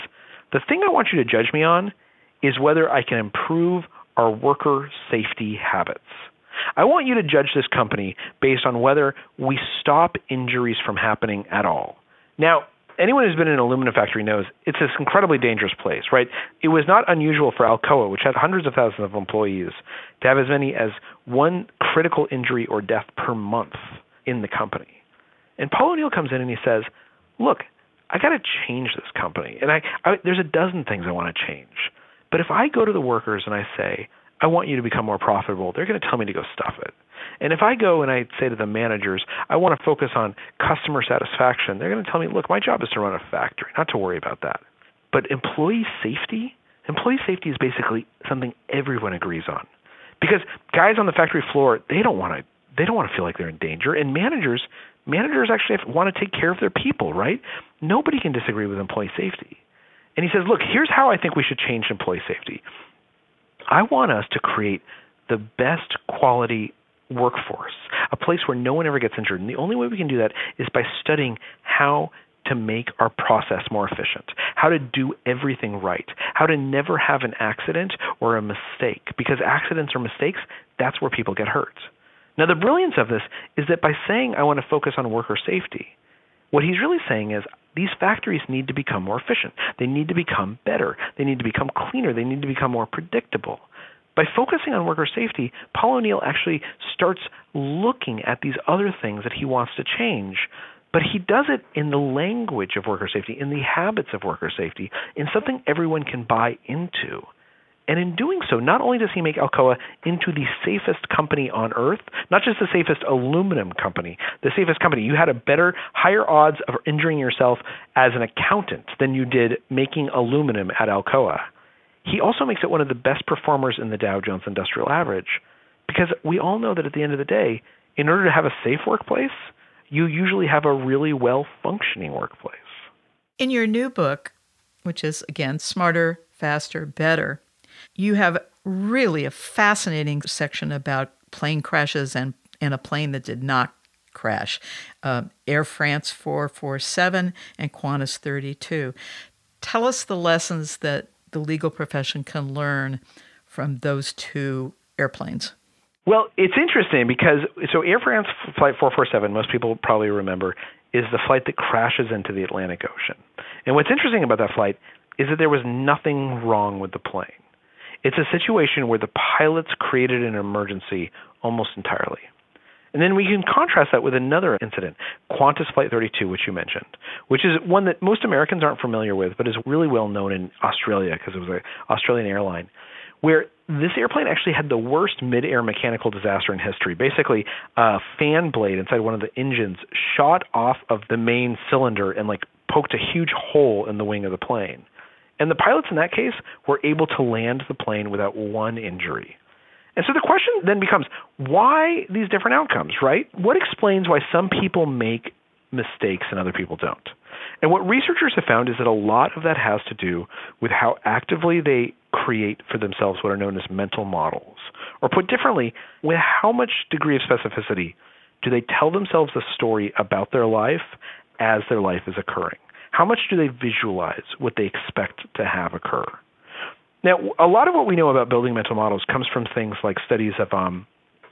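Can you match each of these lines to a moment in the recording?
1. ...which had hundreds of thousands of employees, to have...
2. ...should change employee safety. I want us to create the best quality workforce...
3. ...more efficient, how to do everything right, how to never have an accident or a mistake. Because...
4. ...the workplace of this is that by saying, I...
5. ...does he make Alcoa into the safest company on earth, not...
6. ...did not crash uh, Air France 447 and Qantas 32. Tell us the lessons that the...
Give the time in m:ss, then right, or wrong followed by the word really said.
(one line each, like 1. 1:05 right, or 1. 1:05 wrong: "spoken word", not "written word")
1. 0:18 right
2. 1:01 right
3. 1:13 right
4. 1:22 wrong: "brilliance", not "workplace"
5. 1:48 right
6. 2:23 right.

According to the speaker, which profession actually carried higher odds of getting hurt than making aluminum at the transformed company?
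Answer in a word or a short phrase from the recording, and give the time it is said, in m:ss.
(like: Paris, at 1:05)
Accountant, at 1:58.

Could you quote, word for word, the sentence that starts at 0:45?
But employee safety, employee safety is basically something everyone agrees on.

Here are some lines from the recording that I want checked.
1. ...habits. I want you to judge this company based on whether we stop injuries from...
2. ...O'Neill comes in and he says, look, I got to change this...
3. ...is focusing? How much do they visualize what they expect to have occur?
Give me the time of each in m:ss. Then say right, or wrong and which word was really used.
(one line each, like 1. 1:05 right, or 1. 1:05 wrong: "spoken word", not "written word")
1. 0:05 right
2. 0:25 right
3. 3:42 wrong: "occurring", not "focusing".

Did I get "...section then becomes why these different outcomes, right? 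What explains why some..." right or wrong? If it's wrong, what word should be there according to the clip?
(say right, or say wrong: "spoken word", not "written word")
wrong: "question", not "section".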